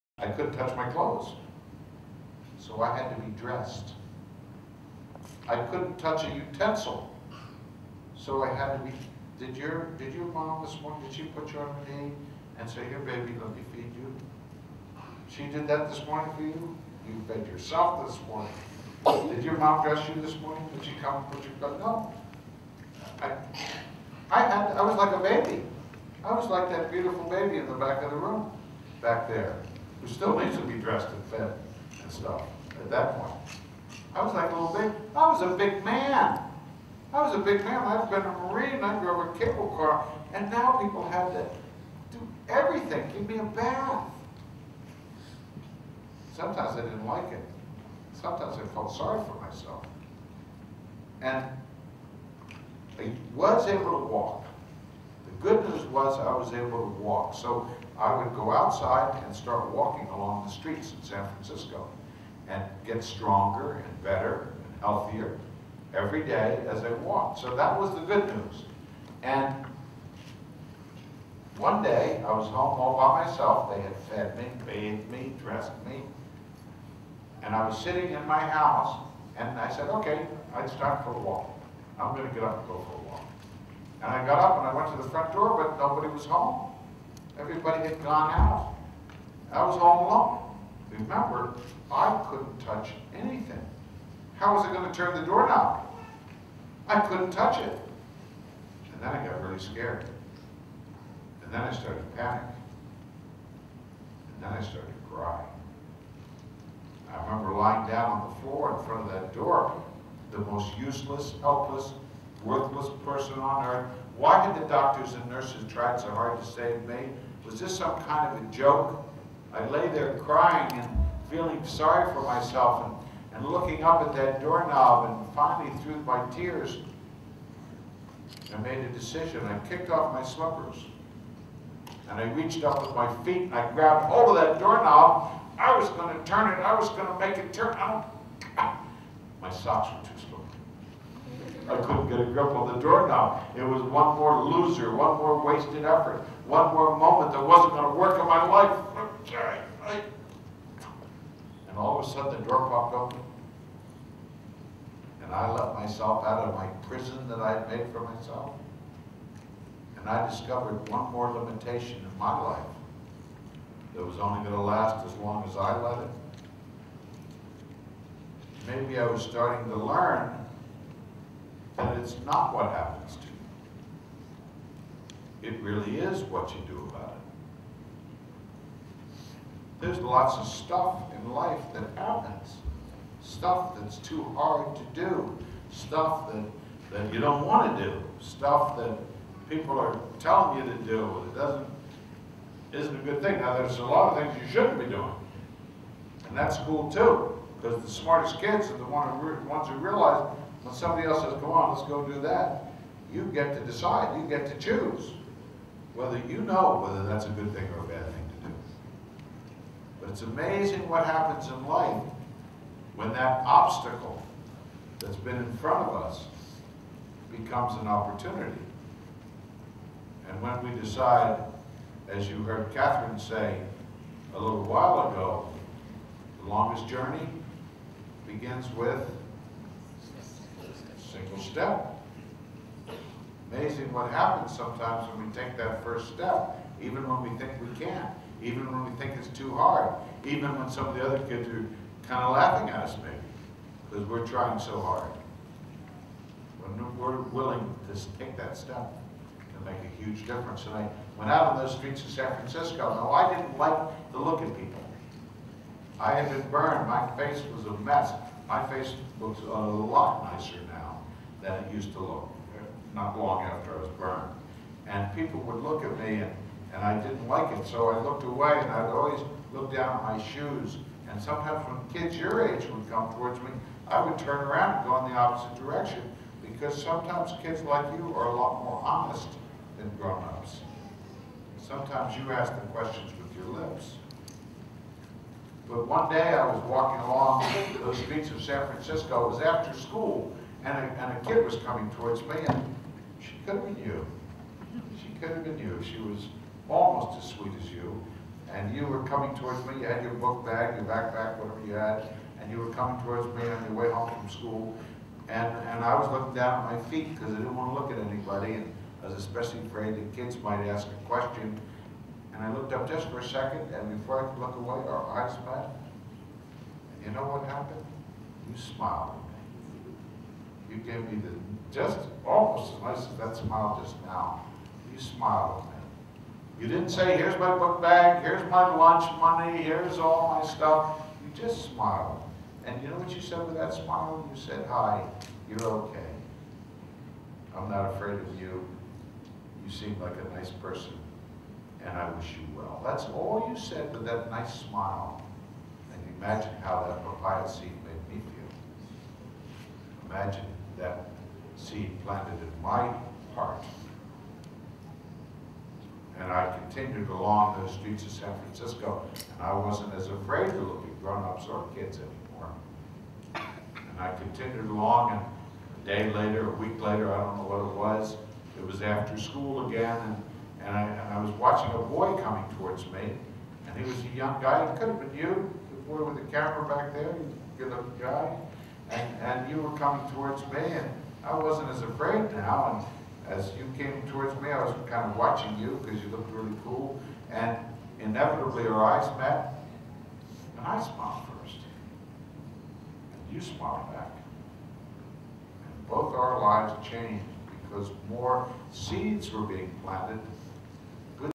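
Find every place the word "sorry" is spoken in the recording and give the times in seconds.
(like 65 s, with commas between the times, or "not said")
48 s, 121 s.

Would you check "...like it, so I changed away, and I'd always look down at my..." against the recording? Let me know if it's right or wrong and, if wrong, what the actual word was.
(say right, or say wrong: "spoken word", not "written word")
wrong: "looked", not "changed".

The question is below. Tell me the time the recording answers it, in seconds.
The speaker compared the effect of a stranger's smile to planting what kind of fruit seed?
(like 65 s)
347 s.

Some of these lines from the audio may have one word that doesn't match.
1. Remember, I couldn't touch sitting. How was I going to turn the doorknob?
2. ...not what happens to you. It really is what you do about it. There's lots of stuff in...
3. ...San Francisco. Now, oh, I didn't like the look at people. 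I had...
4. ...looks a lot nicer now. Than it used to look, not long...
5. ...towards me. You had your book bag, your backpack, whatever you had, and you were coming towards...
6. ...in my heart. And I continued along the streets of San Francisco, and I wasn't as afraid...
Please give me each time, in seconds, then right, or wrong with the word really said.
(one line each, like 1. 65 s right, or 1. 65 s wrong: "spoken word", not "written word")
1. 91 s wrong: "anything", not "sitting"
2. 172 s right
3. 252 s right
4. 259 s right
5. 299 s right
6. 352 s right.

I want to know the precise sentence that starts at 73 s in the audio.
They had fed me, bathed me, dressed me.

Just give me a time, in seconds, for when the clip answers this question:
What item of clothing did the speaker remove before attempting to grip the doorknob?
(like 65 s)
129 s.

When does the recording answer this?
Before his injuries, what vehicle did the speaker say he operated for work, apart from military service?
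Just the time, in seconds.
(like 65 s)
38 s.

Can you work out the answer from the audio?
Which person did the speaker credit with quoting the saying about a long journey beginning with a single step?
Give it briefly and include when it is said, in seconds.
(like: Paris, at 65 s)
Catherine, at 222 s.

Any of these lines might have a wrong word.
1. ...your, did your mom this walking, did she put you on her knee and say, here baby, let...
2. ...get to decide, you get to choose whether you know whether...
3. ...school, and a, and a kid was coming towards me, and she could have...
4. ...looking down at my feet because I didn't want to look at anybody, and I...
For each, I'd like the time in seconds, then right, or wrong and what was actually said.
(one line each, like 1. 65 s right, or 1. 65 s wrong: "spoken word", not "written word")
1. 9 s wrong: "morning", not "walking"
2. 203 s right
3. 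289 s right
4. 306 s right.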